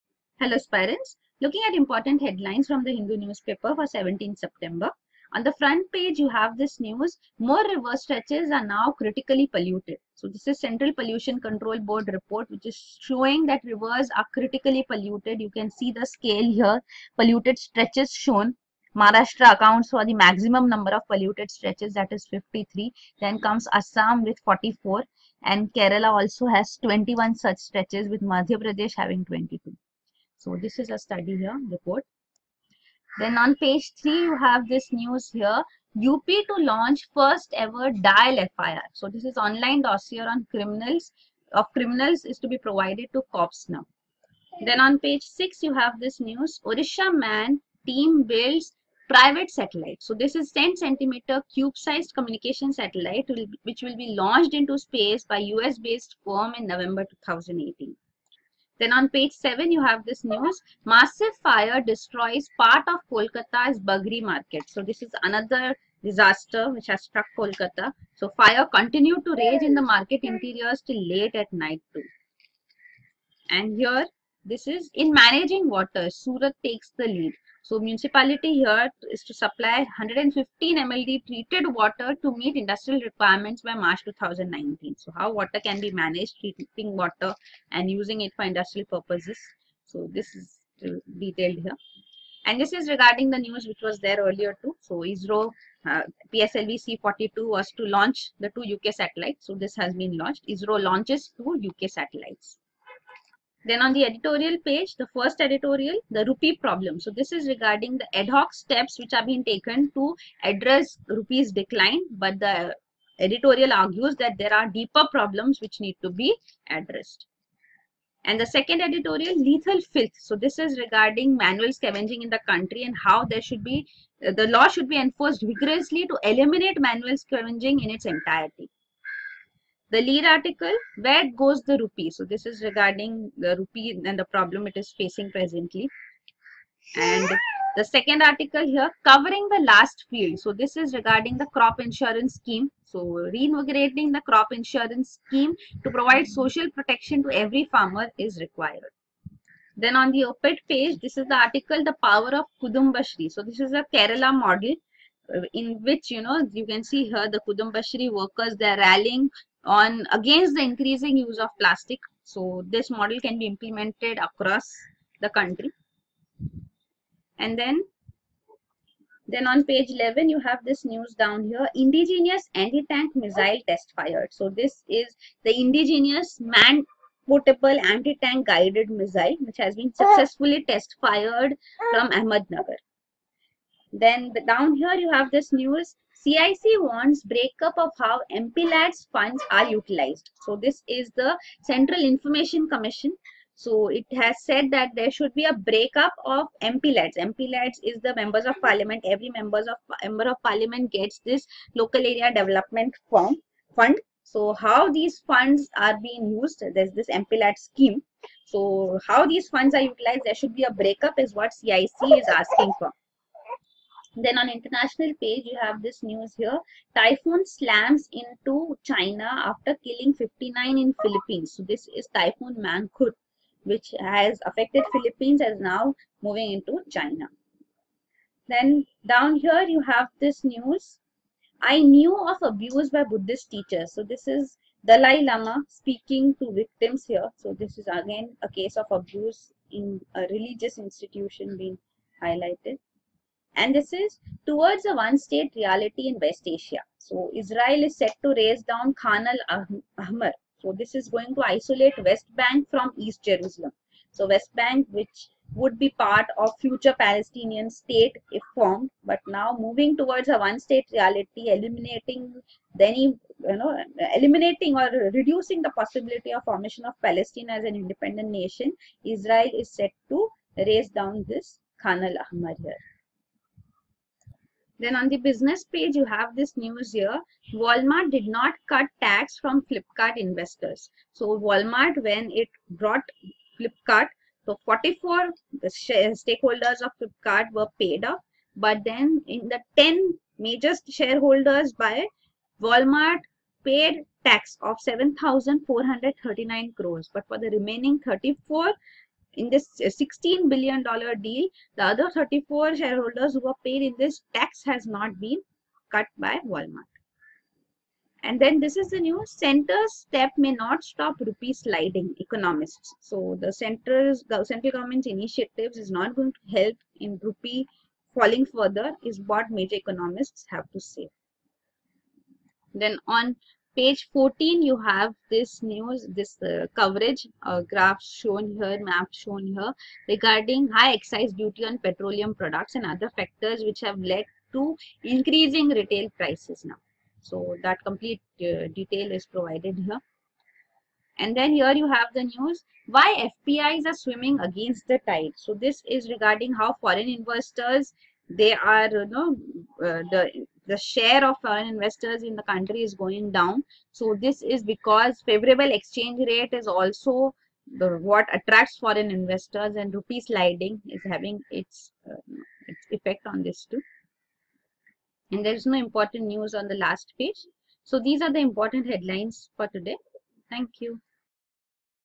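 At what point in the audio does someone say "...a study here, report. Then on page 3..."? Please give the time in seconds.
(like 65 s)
30 s.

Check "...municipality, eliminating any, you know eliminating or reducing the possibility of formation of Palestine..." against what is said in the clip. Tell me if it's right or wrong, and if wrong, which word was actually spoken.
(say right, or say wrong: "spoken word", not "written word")
wrong: "reality", not "municipality".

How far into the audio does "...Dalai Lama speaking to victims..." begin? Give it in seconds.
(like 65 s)
234 s.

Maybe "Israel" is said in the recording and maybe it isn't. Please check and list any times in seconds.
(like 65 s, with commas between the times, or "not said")
247 s, 269 s.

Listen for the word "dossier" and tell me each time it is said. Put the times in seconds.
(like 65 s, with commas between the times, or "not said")
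39 s.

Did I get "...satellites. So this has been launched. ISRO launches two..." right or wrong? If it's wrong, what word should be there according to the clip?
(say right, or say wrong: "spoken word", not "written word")
right.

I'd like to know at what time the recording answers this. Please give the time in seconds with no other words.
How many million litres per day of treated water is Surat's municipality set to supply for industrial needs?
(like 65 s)
79 s.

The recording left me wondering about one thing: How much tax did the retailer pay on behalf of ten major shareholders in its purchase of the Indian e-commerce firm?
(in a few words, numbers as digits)
7,439 crores.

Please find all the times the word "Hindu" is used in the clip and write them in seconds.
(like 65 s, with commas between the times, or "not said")
2 s.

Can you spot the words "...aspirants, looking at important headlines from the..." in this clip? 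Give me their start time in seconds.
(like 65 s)
0 s.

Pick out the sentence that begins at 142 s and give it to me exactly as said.
So reinvigorating the crop insurance scheme to provide social protection to every farmer is required.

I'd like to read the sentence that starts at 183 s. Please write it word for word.
Then the, down here, you have this news, CIC wants breakup of how MPLAD's funds are utilized.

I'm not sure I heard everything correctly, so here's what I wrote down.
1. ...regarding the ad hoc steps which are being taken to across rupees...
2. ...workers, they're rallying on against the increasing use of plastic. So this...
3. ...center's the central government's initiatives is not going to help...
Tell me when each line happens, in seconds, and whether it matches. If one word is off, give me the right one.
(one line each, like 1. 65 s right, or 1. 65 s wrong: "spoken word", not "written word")
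1. 107 s wrong: "address", not "across"
2. 158 s right
3. 313 s right.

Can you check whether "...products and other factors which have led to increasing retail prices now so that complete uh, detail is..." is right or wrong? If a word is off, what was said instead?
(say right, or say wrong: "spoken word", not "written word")
right.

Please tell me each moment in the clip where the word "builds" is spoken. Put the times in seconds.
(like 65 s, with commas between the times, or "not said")
48 s.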